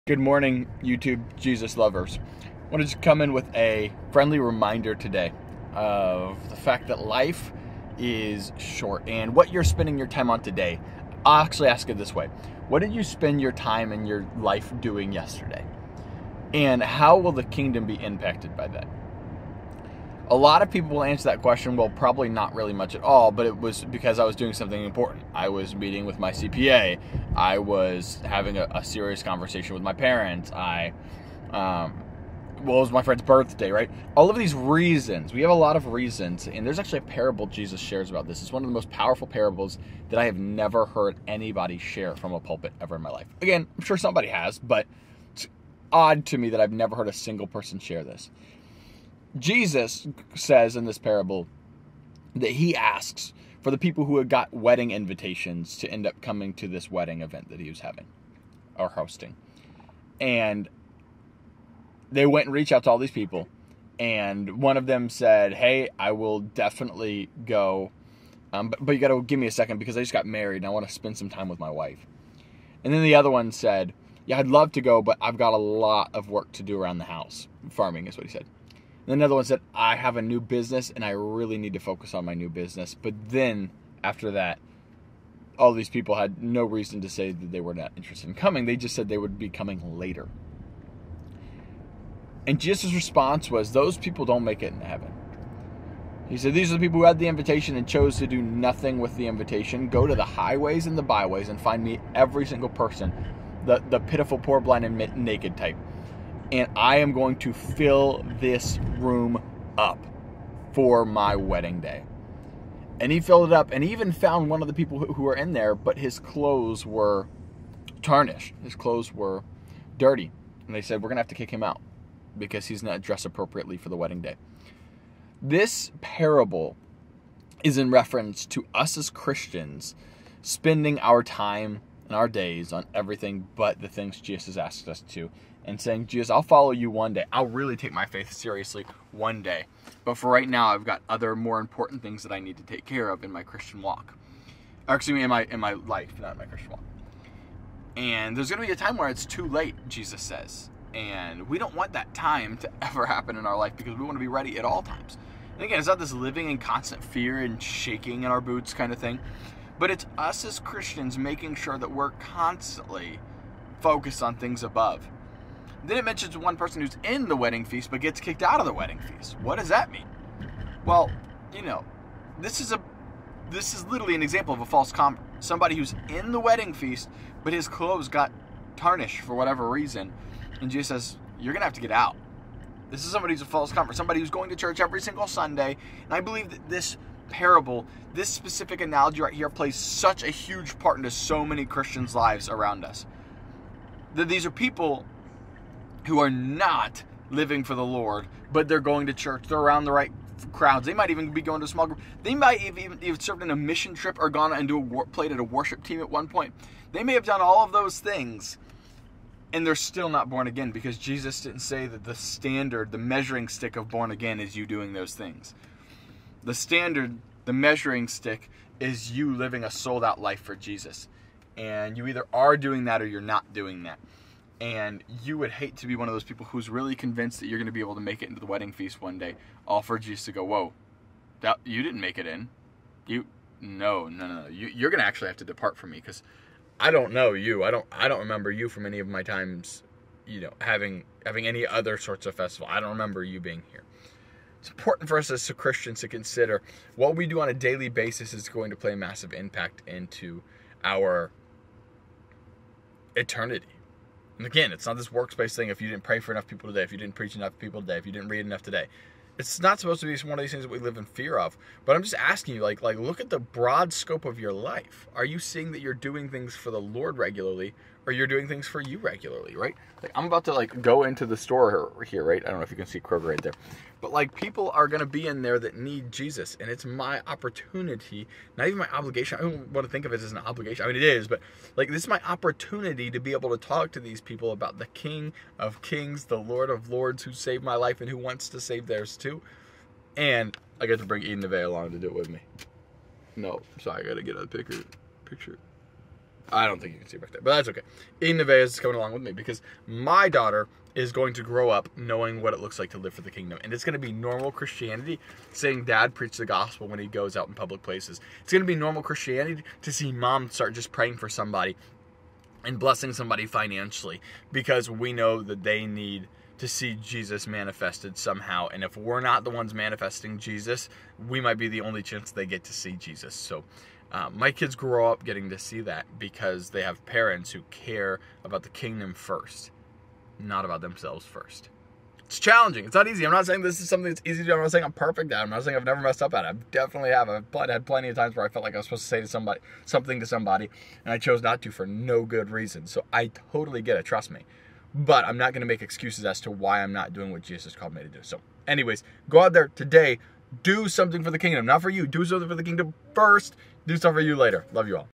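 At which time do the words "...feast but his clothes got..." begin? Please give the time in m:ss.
2:56.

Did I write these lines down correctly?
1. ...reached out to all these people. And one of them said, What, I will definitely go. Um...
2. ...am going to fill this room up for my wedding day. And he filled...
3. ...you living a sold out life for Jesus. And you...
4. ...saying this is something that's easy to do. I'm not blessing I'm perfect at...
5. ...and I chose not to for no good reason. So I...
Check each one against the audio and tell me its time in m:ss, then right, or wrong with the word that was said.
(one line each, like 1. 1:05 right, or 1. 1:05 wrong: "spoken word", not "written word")
1. 1:02 wrong: "Hey", not "What"
2. 1:46 right
3. 3:39 right
4. 5:33 wrong: "saying", not "blessing"
5. 5:41 right.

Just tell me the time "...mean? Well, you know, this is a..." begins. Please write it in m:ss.
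2:49.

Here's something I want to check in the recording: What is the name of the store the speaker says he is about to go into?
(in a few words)
Kroger.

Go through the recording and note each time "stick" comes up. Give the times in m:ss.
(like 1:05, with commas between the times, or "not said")
3:33, 3:38.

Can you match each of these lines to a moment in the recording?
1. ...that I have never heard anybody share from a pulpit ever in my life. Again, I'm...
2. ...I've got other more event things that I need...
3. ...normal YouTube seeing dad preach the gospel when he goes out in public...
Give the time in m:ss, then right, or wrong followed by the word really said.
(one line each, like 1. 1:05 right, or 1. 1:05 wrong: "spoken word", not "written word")
1. 0:40 right
2. 2:20 wrong: "important", not "event"
3. 5:04 wrong: "Christianity", not "YouTube".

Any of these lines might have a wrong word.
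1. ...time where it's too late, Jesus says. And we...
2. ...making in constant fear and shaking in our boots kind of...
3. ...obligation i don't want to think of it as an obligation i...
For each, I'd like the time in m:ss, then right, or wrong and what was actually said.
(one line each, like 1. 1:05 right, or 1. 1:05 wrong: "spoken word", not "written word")
1. 2:28 right
2. 2:36 wrong: "living", not "making"
3. 4:38 right.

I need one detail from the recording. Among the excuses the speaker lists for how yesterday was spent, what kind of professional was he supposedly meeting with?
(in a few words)
CPA.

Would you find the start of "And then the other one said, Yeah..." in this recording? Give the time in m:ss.
1:12.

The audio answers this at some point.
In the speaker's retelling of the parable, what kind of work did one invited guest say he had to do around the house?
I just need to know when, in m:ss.
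1:17.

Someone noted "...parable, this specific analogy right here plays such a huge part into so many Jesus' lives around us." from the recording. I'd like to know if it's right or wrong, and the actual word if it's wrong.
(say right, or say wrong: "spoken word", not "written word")
wrong: "Christians", not "Jesus".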